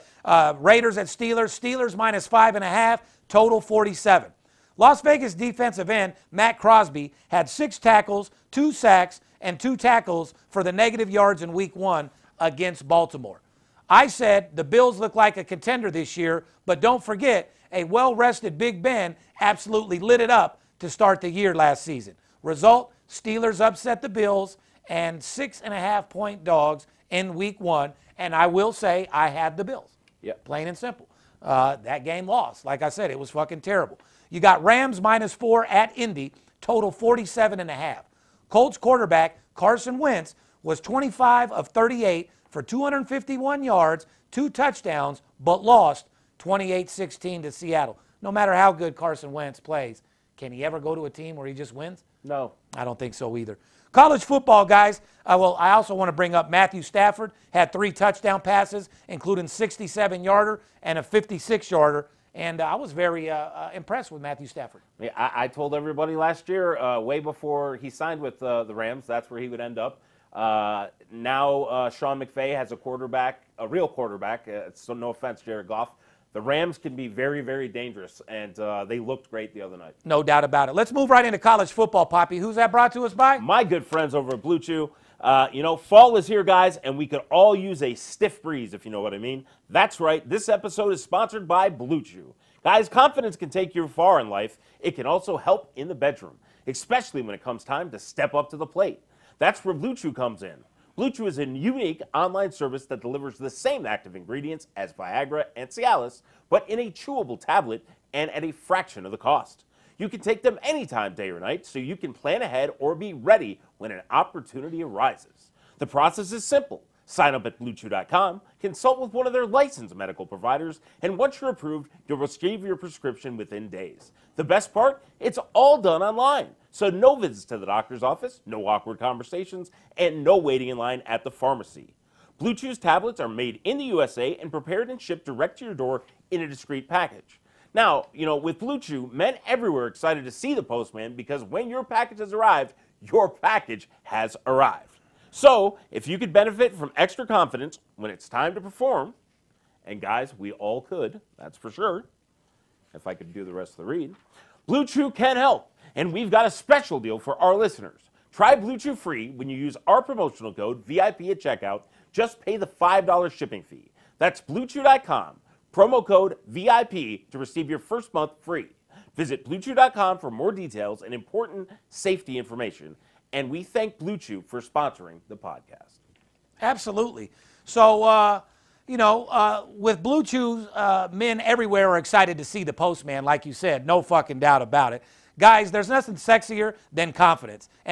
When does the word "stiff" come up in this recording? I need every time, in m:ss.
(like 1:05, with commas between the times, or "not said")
1:27.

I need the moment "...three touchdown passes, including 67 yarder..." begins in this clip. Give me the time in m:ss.
0:57.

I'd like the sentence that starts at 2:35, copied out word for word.
And we've got a special deal for our listeners.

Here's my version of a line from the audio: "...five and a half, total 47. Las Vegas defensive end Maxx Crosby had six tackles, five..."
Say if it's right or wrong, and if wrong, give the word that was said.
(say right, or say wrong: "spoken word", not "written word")
wrong: "two", not "five".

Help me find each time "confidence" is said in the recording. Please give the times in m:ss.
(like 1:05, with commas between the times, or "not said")
1:32, 2:27, 3:07.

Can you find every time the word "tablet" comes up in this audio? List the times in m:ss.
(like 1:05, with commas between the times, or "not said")
1:47, 2:12.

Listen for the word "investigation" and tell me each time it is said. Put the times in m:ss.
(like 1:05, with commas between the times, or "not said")
not said.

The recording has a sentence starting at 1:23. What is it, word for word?
My good friends over at Blue Chew.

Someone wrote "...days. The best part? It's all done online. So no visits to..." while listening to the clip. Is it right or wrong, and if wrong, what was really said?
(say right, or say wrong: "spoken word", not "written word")
right.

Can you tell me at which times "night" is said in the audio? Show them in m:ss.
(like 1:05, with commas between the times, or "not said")
1:19, 1:51.